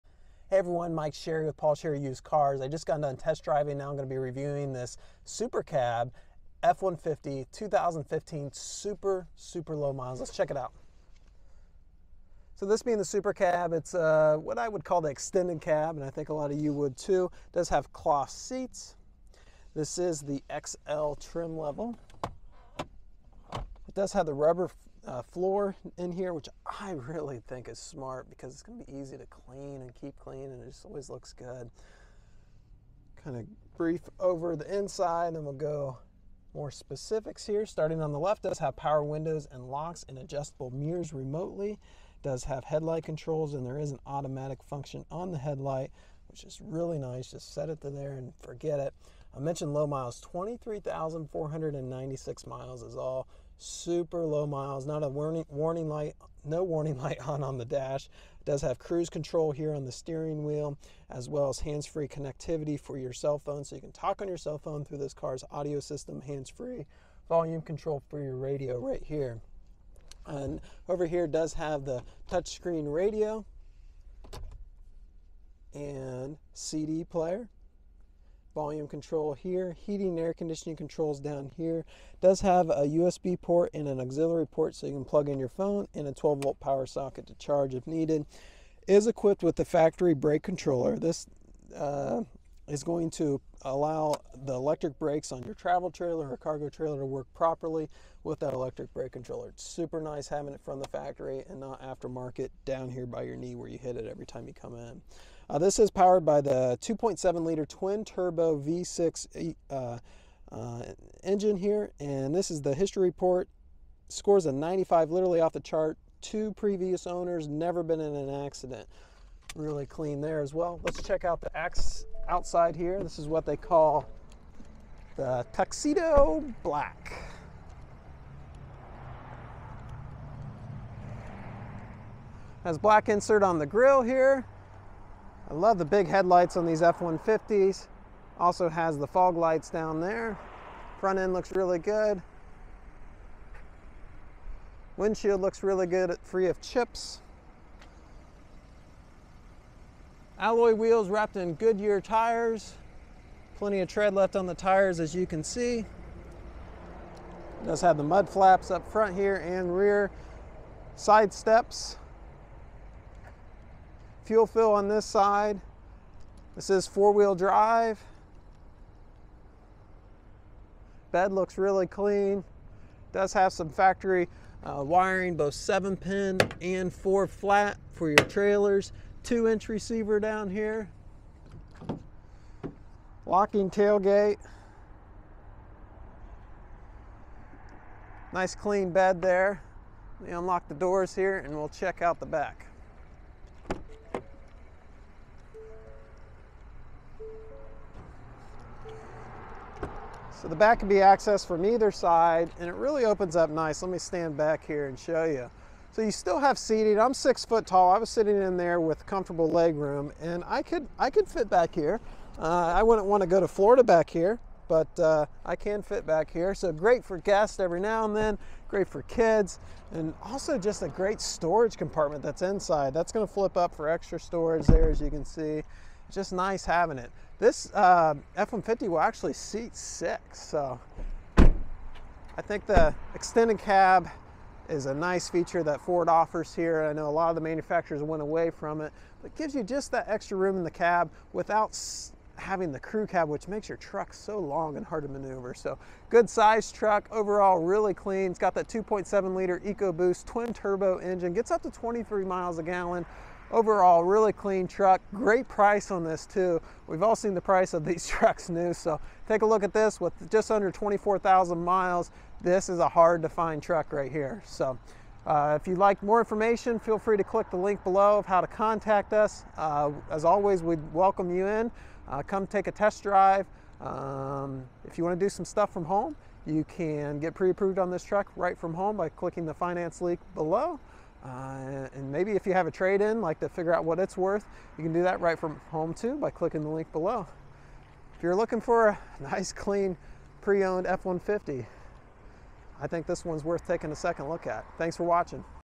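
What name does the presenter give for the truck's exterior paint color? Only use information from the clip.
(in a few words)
Tuxedo black.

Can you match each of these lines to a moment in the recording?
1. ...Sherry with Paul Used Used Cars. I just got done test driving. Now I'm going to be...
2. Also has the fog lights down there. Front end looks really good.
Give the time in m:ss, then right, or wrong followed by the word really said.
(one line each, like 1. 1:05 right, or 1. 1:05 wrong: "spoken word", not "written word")
1. 0:01 wrong: "Sherry", not "Used"
2. 2:18 right.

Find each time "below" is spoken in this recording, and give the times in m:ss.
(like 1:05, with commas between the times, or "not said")
4:27, 4:40, 4:46.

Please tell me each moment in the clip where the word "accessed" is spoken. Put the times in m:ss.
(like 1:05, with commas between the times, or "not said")
3:20.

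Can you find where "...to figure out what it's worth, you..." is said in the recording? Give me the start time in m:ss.
4:43.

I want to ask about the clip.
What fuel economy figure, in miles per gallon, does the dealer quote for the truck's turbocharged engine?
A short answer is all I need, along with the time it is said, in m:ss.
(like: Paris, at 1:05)
23, at 4:11.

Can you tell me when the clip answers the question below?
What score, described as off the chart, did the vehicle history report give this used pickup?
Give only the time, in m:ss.
1:54.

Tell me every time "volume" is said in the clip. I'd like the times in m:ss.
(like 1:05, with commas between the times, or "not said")
1:07, 1:18.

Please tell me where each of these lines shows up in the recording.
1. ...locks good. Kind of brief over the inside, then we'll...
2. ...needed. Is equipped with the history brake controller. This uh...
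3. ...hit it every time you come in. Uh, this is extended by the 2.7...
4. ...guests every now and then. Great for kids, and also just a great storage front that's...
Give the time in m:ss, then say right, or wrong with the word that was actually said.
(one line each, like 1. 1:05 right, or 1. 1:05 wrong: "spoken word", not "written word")
1. 0:31 wrong: "looks", not "locks"
2. 1:27 wrong: "factory", not "history"
3. 1:43 wrong: "powered", not "extended"
4. 3:37 wrong: "compartment", not "front".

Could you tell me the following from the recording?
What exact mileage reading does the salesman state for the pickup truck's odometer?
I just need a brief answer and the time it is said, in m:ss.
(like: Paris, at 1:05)
23,496 miles, at 0:50.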